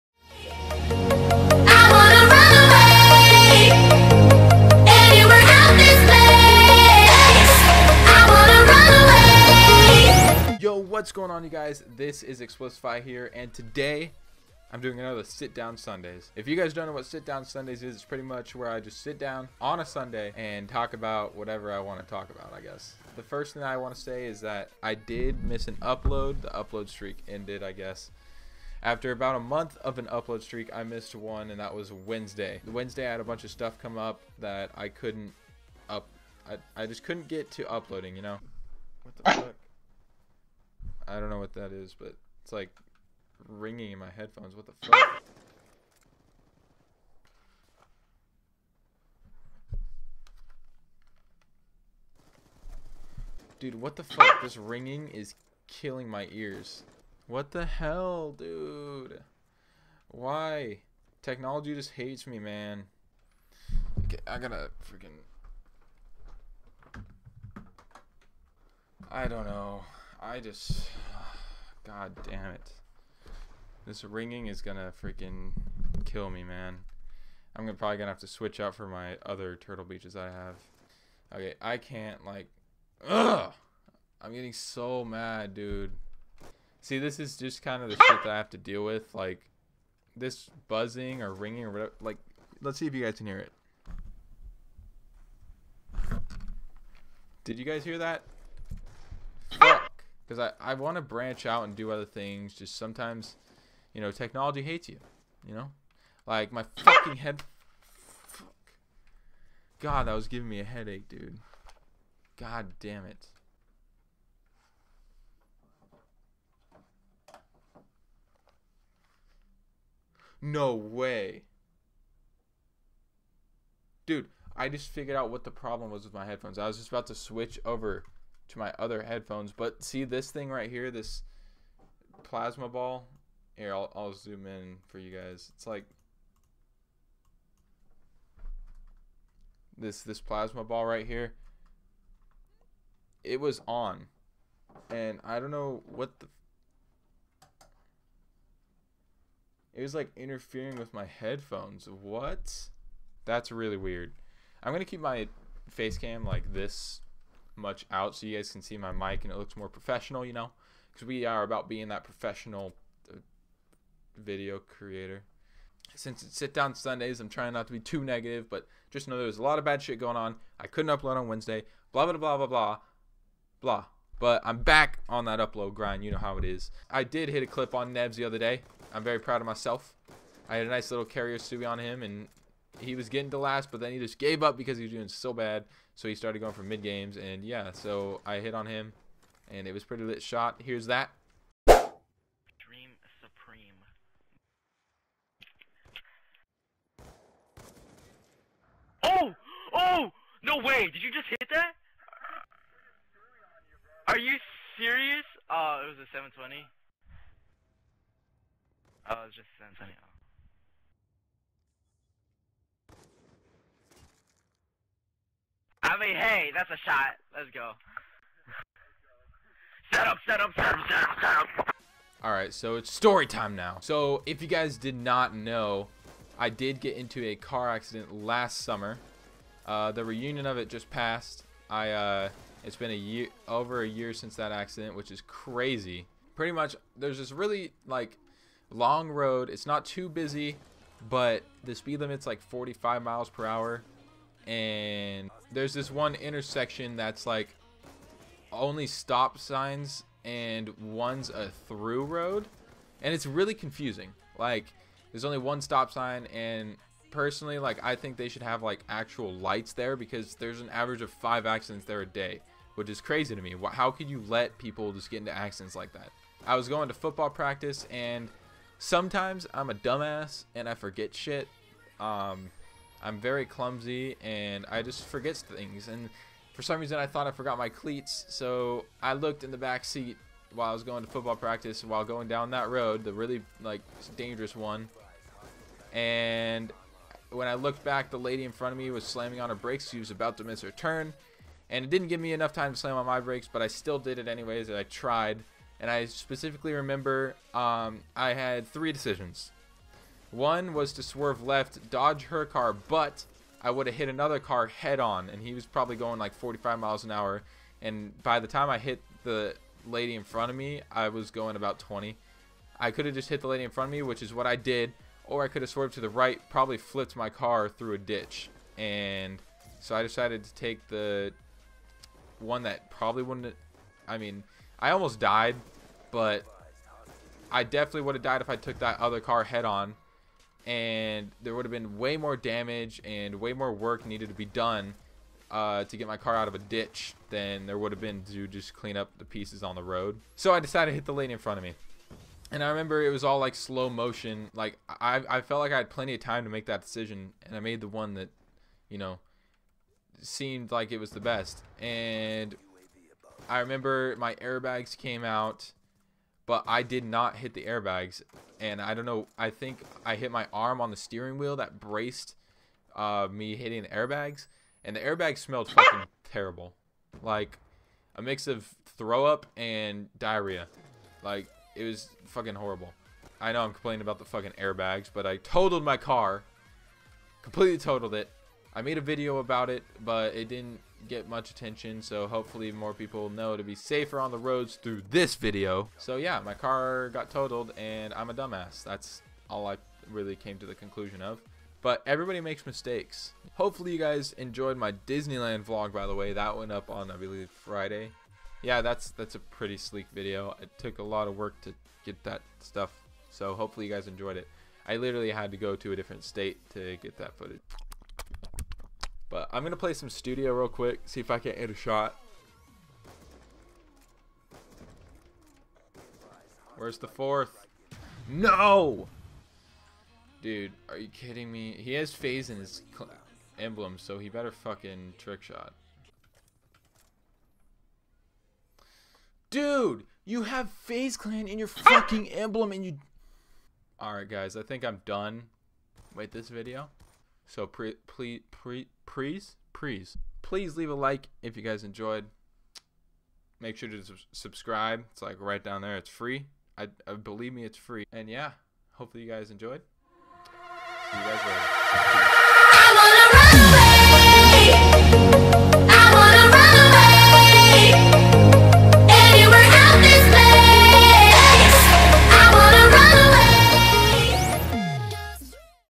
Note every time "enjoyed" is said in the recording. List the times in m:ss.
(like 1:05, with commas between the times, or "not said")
6:34, 6:44, 7:21, 7:29.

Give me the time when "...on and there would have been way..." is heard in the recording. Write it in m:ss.
5:29.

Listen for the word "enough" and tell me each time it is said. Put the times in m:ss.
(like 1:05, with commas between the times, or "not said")
4:52.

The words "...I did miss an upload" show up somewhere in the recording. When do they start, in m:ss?
0:24.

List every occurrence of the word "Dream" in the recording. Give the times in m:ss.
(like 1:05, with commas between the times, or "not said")
3:11.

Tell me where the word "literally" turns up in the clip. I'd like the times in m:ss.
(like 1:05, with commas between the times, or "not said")
6:44.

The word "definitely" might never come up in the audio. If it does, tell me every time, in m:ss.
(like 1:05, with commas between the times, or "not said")
5:27.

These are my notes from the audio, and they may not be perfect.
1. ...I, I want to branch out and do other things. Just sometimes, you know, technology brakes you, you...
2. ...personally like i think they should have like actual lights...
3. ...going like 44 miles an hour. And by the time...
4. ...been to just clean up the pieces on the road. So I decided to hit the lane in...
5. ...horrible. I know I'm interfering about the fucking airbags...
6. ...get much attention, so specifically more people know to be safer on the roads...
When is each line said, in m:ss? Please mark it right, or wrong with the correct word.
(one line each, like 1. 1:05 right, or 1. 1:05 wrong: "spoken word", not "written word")
1. 1:40 wrong: "hates", not "brakes"
2. 4:17 right
3. 5:05 wrong: "45", not "44"
4. 5:37 right
5. 6:12 wrong: "complaining", not "interfering"
6. 6:21 wrong: "hopefully", not "specifically".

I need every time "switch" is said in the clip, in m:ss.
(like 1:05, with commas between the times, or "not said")
1:18, 2:07.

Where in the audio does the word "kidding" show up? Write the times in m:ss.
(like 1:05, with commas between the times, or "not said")
7:01.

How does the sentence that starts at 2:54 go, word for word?
But I'm back on that upload grind.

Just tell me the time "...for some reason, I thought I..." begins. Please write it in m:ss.
4:36.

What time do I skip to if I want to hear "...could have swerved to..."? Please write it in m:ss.
5:15.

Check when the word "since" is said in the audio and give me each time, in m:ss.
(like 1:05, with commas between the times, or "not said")
2:45, 3:54.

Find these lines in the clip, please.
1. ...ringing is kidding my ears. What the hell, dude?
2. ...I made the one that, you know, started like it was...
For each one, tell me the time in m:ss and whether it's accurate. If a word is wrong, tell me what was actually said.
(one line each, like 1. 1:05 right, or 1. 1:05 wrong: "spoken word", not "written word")
1. 0:54 wrong: "killing", not "kidding"
2. 5:47 wrong: "seemed", not "started".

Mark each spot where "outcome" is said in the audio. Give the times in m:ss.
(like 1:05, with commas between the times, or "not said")
not said.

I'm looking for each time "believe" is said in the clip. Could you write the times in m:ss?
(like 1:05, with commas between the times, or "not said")
6:37, 7:27.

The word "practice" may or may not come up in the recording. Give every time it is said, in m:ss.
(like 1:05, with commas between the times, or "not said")
4:27, 4:41.